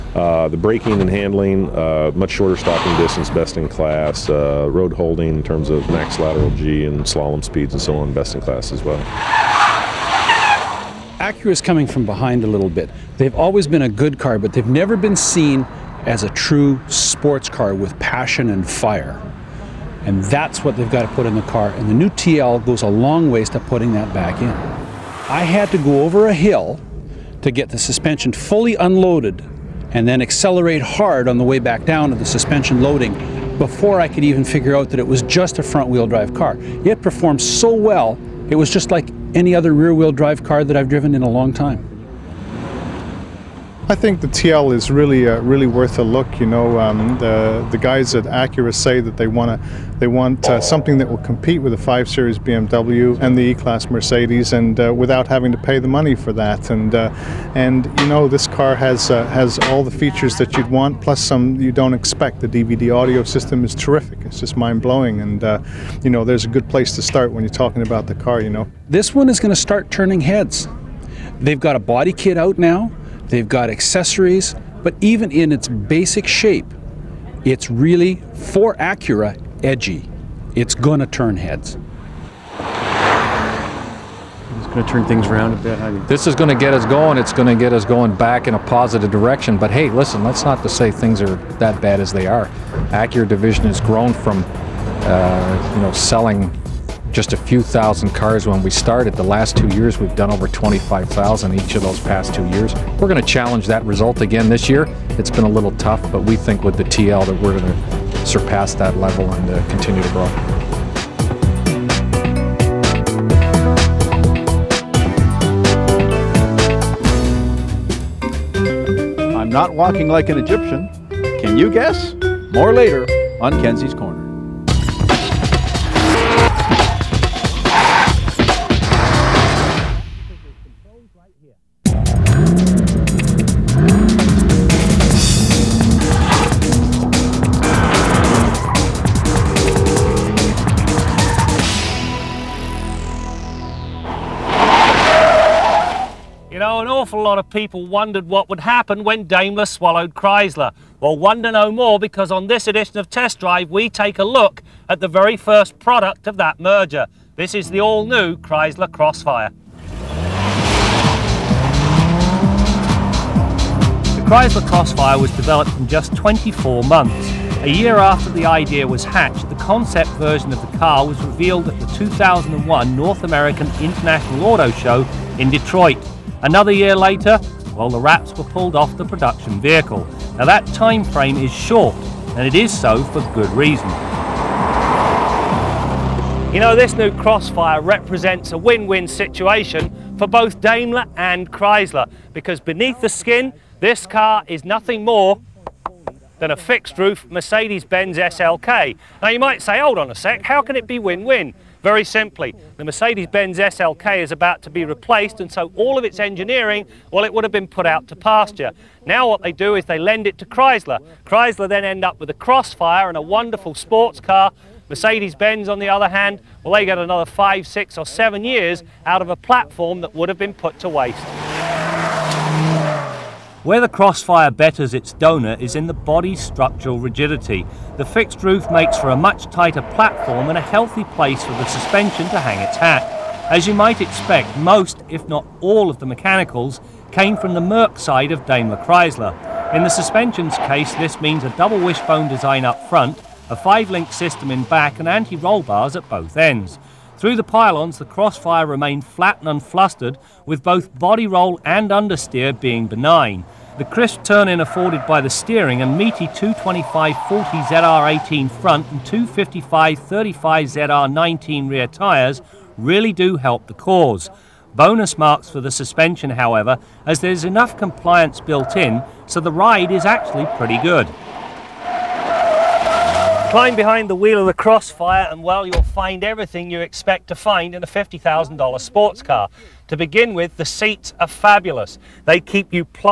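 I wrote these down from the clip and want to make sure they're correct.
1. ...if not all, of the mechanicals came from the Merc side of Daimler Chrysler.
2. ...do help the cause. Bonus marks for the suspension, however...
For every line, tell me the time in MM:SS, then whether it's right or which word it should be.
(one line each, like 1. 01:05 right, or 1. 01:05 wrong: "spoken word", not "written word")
1. 03:55 right
2. 04:23 right.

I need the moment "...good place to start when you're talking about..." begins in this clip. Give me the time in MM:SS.
01:06.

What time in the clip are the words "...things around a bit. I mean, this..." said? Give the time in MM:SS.
01:25.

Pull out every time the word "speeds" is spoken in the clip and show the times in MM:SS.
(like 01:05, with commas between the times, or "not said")
00:07.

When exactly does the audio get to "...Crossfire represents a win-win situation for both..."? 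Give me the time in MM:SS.
03:07.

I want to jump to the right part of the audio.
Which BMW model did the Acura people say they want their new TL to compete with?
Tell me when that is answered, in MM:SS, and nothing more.
00:51.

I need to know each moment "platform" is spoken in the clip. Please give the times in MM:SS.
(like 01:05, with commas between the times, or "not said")
03:39, 03:49.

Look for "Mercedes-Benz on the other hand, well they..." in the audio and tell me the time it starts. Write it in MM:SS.
03:34.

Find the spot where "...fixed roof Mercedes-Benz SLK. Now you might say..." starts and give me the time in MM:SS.
03:16.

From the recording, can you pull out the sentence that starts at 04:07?
Through the pylons, the crossfire remained flat and unflustered, with both body roll and understeer being benign.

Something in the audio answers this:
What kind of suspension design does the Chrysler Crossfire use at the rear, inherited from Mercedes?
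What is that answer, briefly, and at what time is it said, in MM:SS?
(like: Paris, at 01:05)
five link system, at 04:03.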